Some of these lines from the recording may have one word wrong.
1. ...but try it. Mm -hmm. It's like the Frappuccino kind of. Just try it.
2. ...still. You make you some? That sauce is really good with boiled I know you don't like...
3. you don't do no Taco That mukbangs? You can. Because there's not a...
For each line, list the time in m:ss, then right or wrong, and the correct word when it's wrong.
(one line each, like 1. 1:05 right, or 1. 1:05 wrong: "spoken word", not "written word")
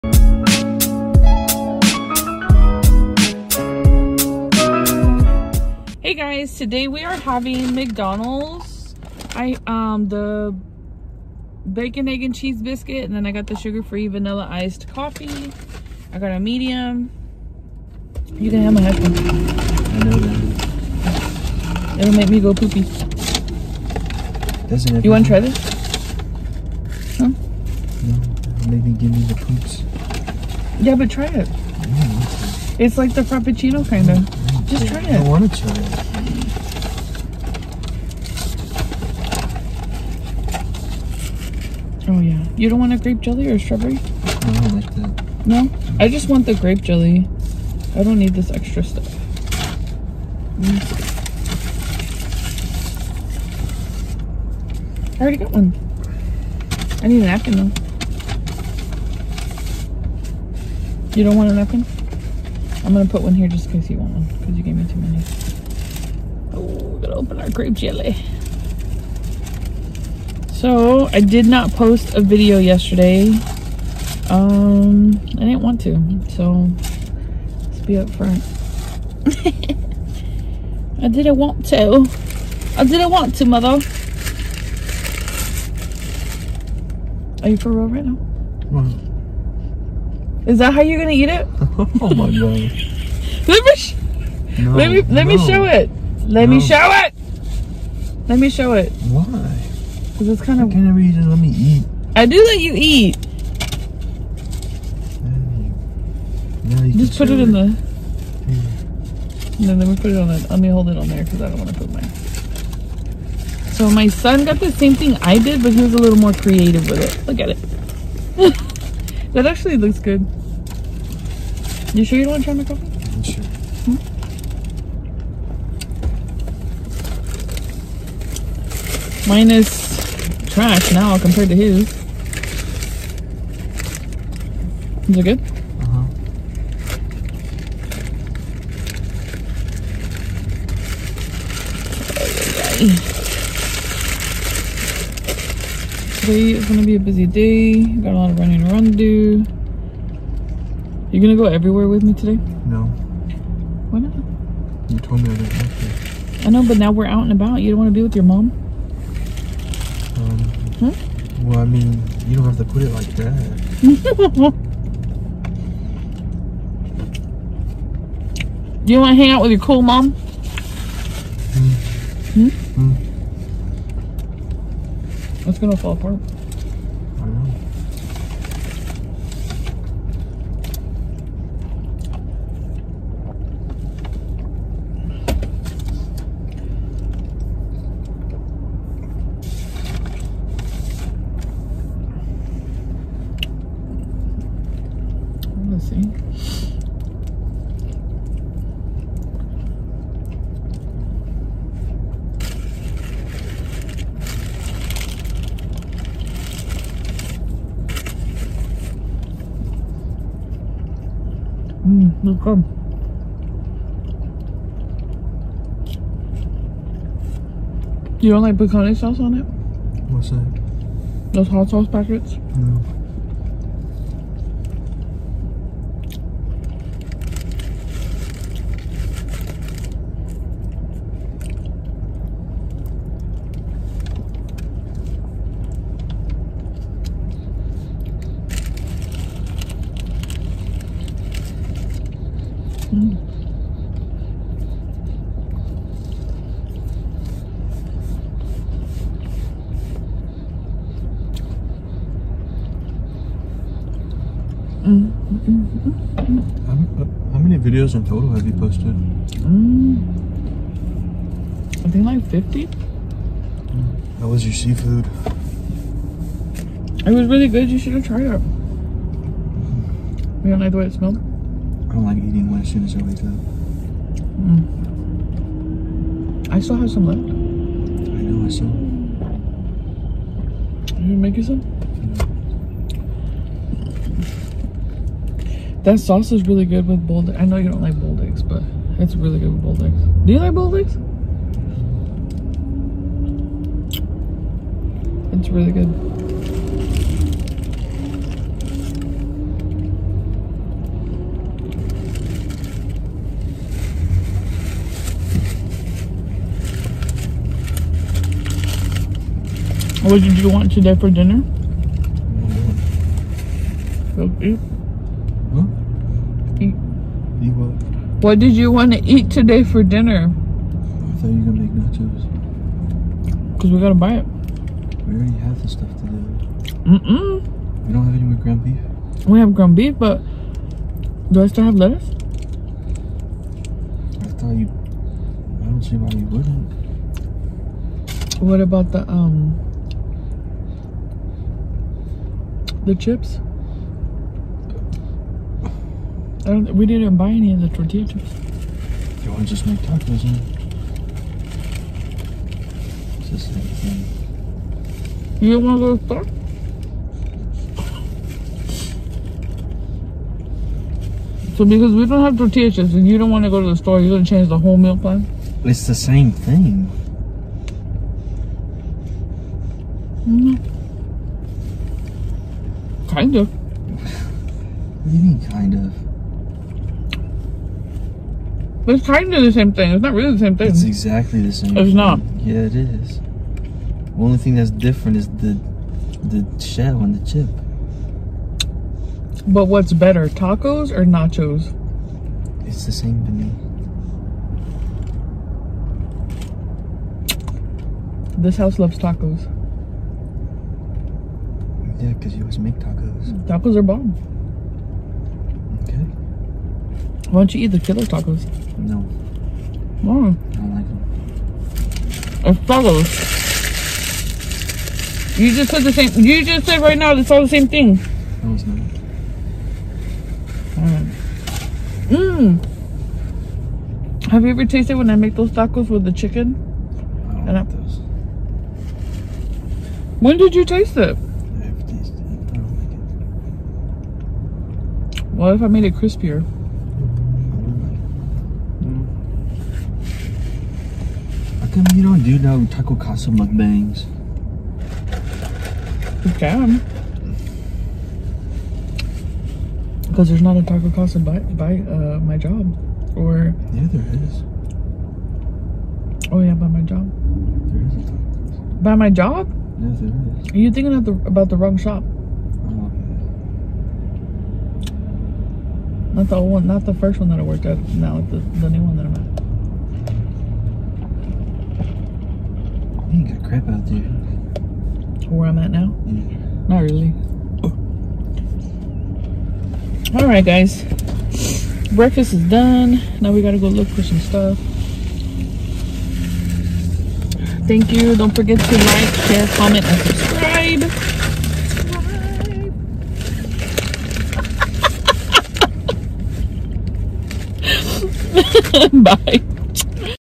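1. 0:30 right
2. 4:38 right
3. 7:21 wrong: "Casa", not "That".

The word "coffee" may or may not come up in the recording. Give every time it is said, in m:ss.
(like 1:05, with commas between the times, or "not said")
0:14, 2:02.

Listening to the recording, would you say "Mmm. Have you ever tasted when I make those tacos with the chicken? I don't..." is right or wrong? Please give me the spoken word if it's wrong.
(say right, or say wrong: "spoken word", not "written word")
right.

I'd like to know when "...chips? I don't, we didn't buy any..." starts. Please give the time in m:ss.
5:42.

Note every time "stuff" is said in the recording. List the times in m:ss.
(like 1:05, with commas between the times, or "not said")
0:48, 5:25, 8:04.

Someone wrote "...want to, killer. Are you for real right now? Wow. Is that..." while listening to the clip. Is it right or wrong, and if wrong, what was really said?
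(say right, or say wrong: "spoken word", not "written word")
wrong: "mother", not "killer".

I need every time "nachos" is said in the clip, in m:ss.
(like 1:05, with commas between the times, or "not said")
5:21, 6:31.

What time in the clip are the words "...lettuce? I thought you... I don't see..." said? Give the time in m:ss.
5:31.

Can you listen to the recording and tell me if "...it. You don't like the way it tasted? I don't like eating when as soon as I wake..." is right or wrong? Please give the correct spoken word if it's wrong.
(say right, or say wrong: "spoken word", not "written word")
wrong: "smelled", not "tasted".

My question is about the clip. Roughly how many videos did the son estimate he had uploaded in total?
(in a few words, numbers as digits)
50.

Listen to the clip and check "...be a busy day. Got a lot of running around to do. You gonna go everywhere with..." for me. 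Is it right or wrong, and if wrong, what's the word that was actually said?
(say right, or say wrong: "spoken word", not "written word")
right.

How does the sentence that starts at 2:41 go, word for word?
Well, I mean, you don't have to put it like that.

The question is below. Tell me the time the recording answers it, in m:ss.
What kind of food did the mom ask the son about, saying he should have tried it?
4:24.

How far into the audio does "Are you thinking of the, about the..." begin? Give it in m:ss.
7:40.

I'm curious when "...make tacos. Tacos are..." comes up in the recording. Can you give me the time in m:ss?
6:42.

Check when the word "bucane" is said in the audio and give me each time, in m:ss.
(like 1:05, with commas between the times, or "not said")
3:38.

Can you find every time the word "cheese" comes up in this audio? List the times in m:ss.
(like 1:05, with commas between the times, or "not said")
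0:12.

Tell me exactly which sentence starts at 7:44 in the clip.
Oh, not the old one, not the first one that I worked at, Now the, the new one that I'm at.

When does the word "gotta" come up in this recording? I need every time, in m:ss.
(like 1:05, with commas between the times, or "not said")
1:07, 8:03.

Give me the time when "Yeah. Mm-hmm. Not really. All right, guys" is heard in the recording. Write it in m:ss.
7:56.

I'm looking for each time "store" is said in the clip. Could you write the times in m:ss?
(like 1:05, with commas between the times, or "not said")
5:56, 6:03.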